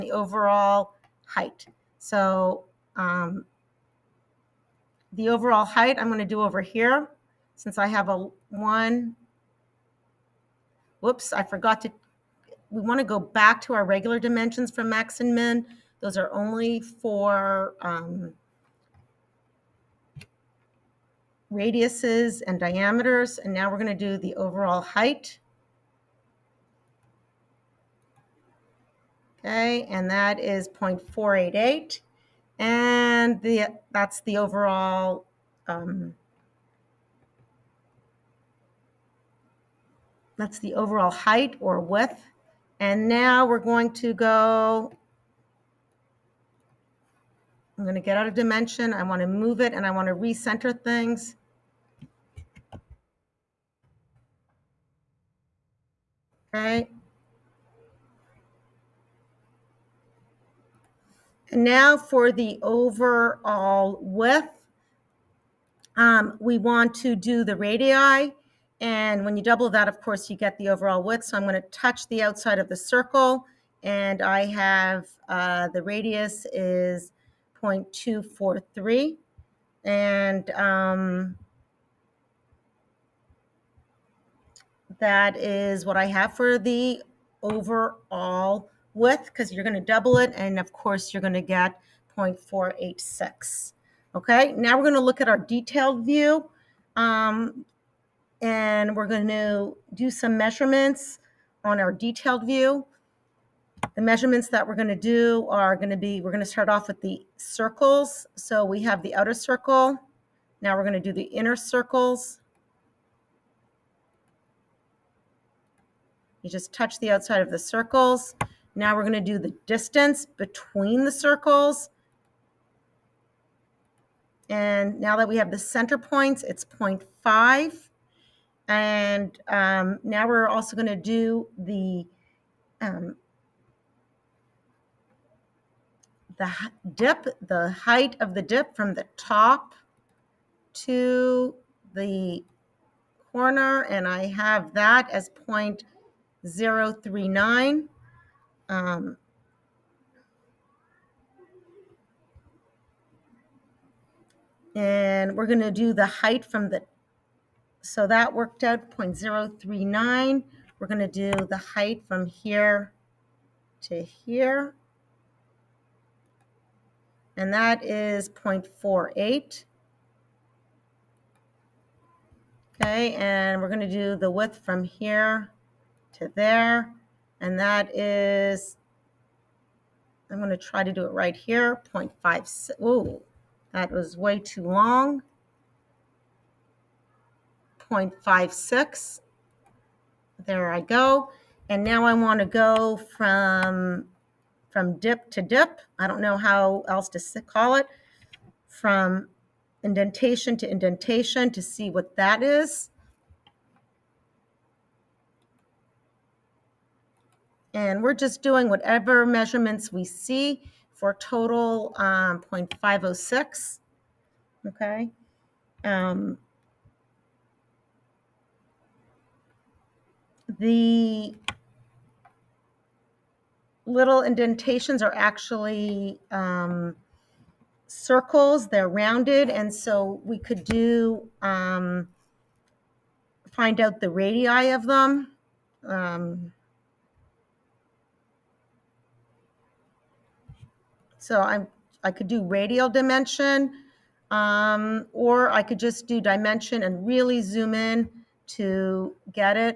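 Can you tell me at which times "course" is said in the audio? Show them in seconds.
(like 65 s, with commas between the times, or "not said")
69 s, 90 s.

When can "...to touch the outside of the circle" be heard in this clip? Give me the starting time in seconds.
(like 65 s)
71 s.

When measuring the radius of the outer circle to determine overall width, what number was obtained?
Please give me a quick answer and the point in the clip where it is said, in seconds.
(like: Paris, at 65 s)
0.243, at 77 s.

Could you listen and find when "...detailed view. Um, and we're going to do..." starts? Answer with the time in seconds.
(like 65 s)
95 s.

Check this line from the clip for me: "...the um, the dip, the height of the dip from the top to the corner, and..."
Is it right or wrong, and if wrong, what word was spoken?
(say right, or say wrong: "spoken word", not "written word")
right.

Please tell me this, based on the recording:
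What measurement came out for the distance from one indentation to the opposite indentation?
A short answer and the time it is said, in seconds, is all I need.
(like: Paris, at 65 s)
0.506, at 212 s.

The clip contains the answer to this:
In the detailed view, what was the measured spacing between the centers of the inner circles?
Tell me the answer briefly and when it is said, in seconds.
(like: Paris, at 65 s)
0.5, at 126 s.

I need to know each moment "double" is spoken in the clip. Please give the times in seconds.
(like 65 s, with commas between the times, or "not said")
69 s, 89 s.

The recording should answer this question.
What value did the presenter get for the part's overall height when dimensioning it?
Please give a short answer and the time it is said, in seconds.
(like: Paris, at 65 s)
0.488, at 30 s.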